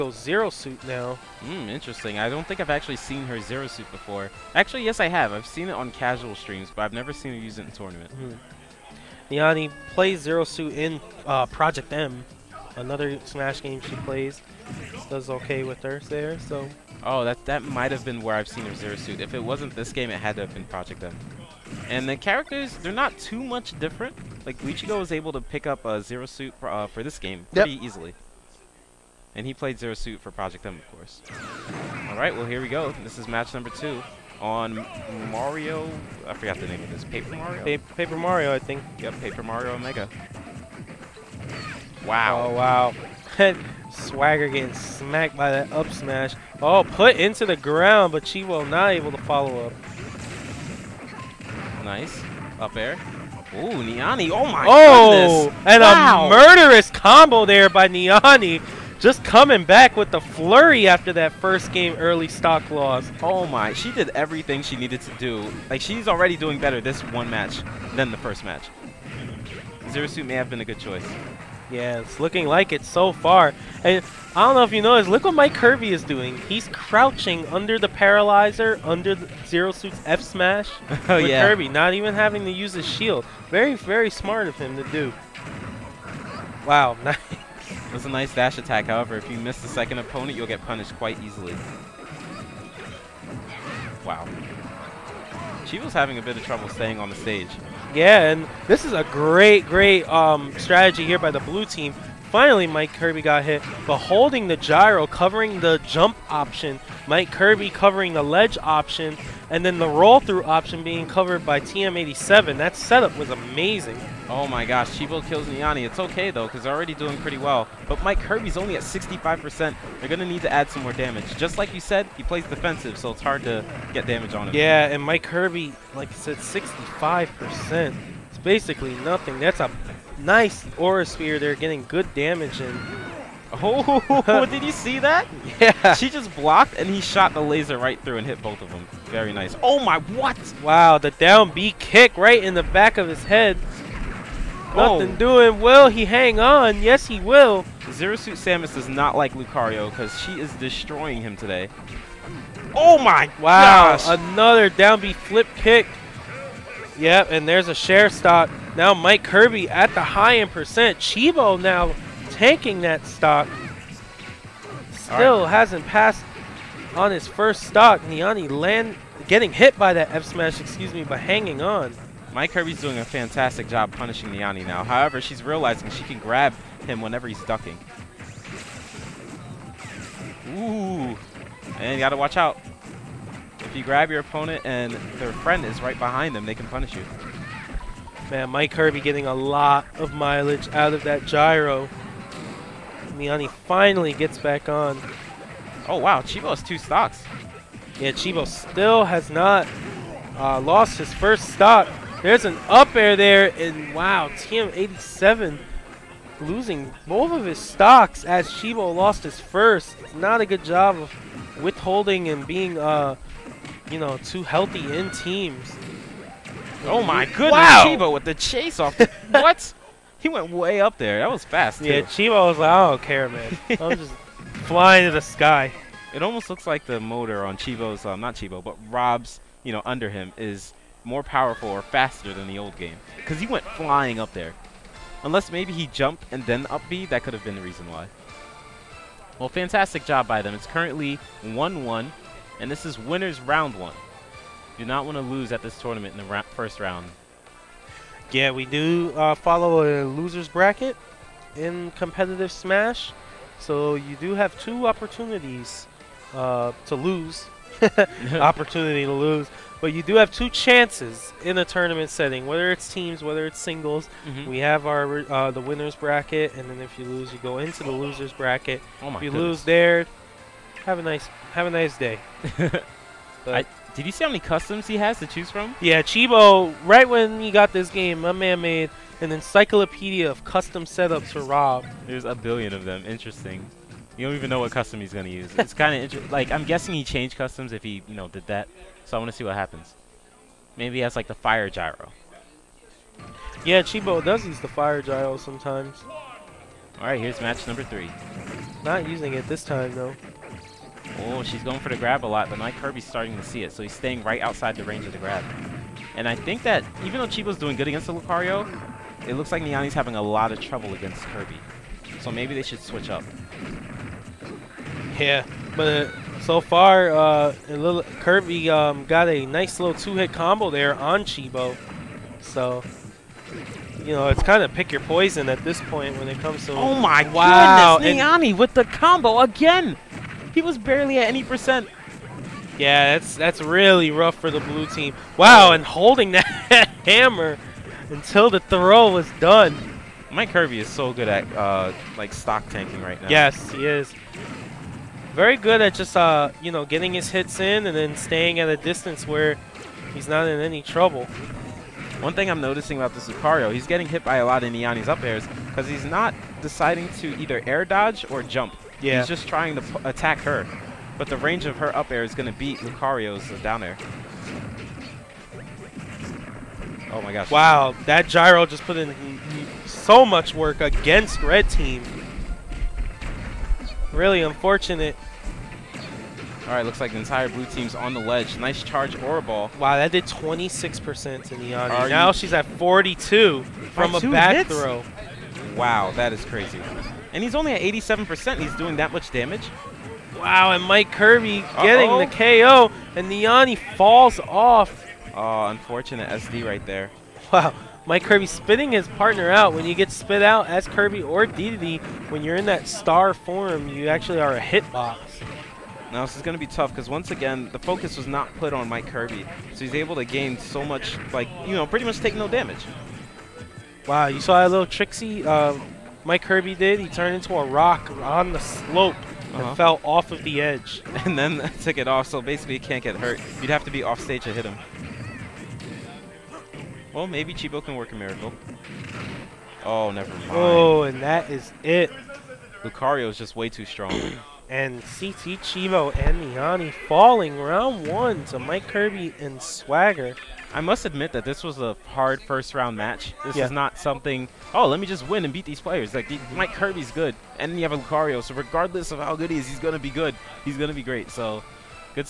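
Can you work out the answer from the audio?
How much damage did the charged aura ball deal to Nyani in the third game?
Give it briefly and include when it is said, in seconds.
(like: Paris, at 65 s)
26%, at 380 s.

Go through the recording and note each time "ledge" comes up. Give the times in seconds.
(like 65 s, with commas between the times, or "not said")
108 s, 378 s.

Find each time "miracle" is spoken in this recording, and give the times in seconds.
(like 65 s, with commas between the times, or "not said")
428 s.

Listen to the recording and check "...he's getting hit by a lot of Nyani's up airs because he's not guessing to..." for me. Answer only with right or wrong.
wrong.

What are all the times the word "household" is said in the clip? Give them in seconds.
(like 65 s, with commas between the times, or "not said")
not said.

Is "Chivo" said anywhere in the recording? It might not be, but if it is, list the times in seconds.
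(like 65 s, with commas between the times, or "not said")
435 s.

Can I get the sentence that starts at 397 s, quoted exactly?
Wow, Mike Kirby spitting his partner out.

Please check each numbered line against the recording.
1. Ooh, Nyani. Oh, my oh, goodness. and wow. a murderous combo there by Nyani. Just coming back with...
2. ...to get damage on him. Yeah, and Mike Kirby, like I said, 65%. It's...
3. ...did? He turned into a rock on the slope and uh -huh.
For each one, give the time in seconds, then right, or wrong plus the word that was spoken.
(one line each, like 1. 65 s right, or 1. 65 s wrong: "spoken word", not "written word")
1. 53 s right
2. 123 s right
3. 416 s right.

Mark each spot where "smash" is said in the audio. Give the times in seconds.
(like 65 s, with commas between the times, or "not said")
13 s, 45 s, 80 s, 170 s, 252 s.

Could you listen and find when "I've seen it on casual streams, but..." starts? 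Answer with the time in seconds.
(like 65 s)
5 s.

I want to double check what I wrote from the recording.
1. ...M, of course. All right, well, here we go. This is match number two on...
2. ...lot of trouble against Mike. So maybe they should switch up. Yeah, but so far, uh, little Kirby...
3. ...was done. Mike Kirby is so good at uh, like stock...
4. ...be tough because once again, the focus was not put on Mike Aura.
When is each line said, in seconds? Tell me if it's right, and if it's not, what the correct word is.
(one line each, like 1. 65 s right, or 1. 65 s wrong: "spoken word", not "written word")
1. 30 s right
2. 310 s wrong: "Kirby", not "Mike"
3. 339 s right
4. 406 s wrong: "Kirby", not "Aura".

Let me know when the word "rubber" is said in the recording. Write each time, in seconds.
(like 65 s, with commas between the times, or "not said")
not said.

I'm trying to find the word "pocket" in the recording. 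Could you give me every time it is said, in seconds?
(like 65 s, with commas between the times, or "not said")
not said.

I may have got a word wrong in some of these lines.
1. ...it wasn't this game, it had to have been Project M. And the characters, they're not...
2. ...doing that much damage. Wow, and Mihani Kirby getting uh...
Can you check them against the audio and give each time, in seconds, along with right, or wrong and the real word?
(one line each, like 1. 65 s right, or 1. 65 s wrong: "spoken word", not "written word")
1. 19 s right
2. 388 s wrong: "Mike", not "Mihani".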